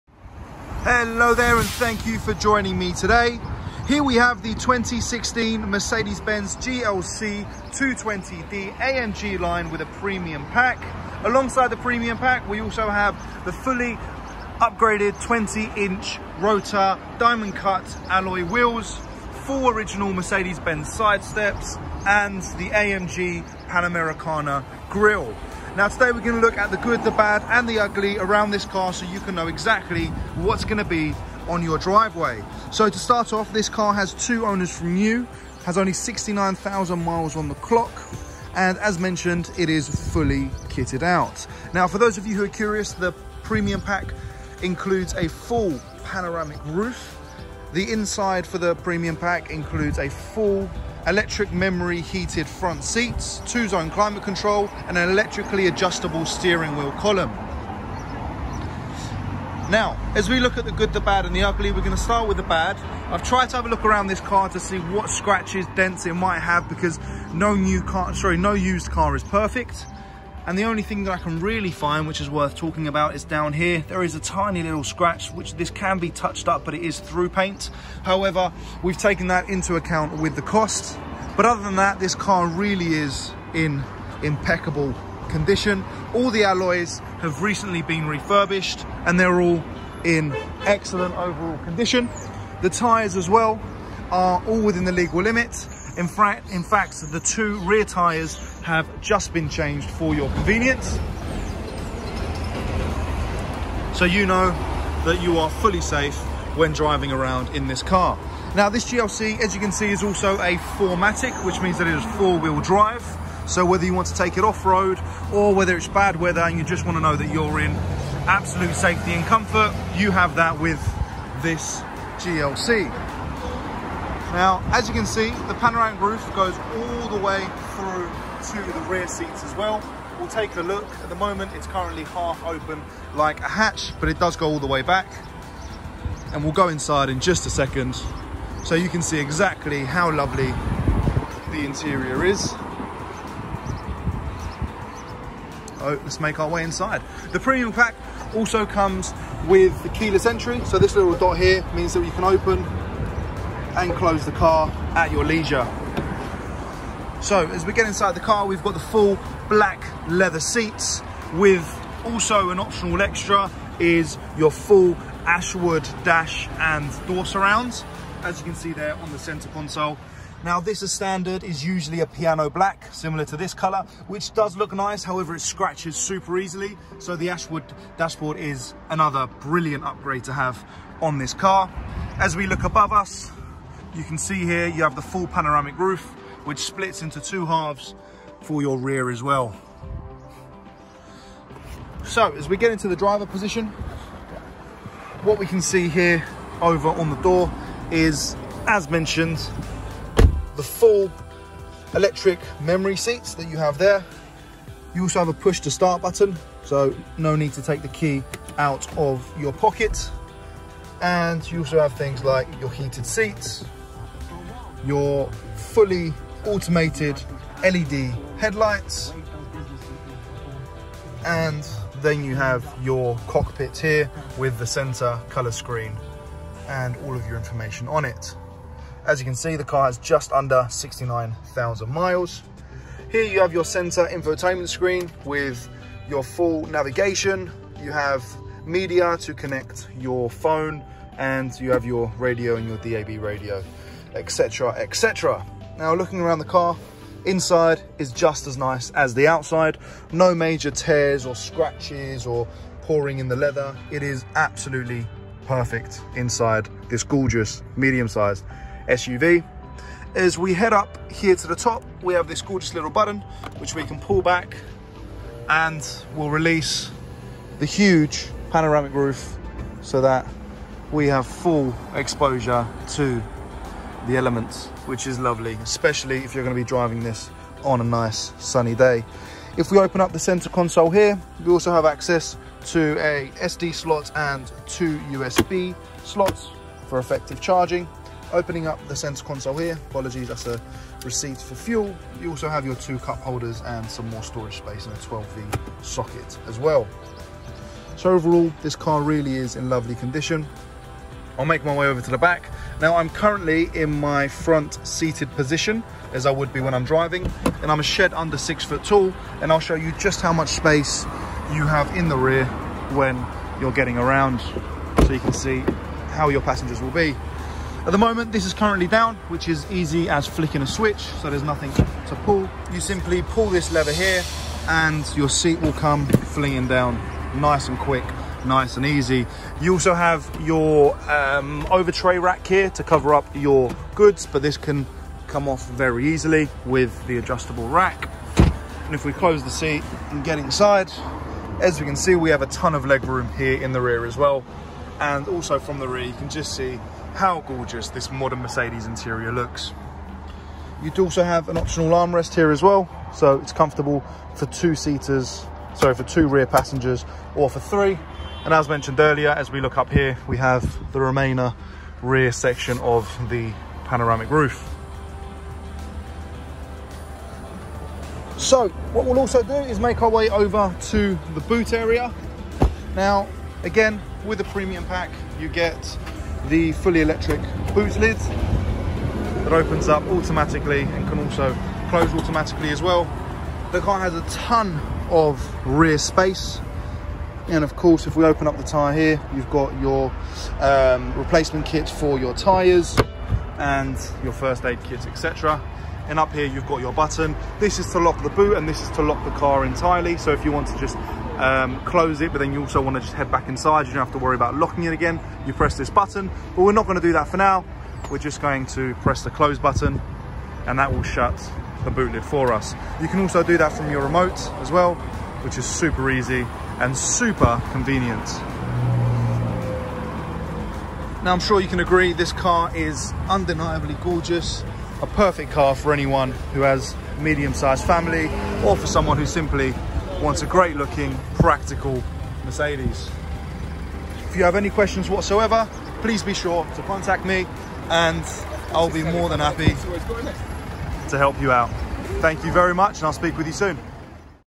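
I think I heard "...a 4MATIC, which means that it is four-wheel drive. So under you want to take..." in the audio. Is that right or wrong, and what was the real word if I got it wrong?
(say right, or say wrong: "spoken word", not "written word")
wrong: "whether", not "under".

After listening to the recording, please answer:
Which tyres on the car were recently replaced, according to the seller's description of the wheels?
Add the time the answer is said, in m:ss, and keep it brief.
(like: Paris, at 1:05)
the two rear tyres, at 1:37.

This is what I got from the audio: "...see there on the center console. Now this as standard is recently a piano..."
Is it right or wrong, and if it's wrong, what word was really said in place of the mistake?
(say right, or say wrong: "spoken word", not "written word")
wrong: "usually", not "recently".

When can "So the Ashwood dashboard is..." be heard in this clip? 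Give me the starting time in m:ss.
2:56.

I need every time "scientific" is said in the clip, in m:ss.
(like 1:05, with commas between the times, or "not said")
not said.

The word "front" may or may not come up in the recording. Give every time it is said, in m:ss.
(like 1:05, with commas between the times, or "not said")
0:52, 5:04.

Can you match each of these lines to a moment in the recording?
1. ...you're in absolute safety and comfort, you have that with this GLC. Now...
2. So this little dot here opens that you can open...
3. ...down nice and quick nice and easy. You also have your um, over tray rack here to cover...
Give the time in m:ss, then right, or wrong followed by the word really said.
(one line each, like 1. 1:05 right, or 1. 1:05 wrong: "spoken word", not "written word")
1. 1:57 right
2. 2:30 wrong: "means", not "opens"
3. 5:26 right.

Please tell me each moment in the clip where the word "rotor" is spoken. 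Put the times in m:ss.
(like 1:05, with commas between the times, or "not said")
0:16.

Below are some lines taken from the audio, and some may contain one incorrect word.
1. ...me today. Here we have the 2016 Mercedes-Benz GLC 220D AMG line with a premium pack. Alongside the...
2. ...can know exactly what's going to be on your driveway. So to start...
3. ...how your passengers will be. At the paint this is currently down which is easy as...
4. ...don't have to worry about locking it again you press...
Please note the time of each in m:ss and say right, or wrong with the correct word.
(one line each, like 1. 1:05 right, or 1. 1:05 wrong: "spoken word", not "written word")
1. 0:02 right
2. 0:29 right
3. 5:16 wrong: "moment", not "paint"
4. 6:43 right.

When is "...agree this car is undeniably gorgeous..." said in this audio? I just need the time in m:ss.
7:01.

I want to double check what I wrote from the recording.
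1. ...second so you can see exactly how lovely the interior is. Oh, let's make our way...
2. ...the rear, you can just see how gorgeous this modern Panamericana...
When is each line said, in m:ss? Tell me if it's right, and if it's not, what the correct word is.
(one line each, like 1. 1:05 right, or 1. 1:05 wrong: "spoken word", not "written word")
1. 2:17 right
2. 5:45 wrong: "Mercedes", not "Panamericana".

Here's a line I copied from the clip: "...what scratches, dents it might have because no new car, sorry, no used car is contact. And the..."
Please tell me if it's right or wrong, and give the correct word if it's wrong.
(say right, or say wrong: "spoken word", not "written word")
wrong: "perfect", not "contact".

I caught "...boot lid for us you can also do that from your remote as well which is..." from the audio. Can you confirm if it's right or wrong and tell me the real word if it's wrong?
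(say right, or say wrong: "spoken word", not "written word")
right.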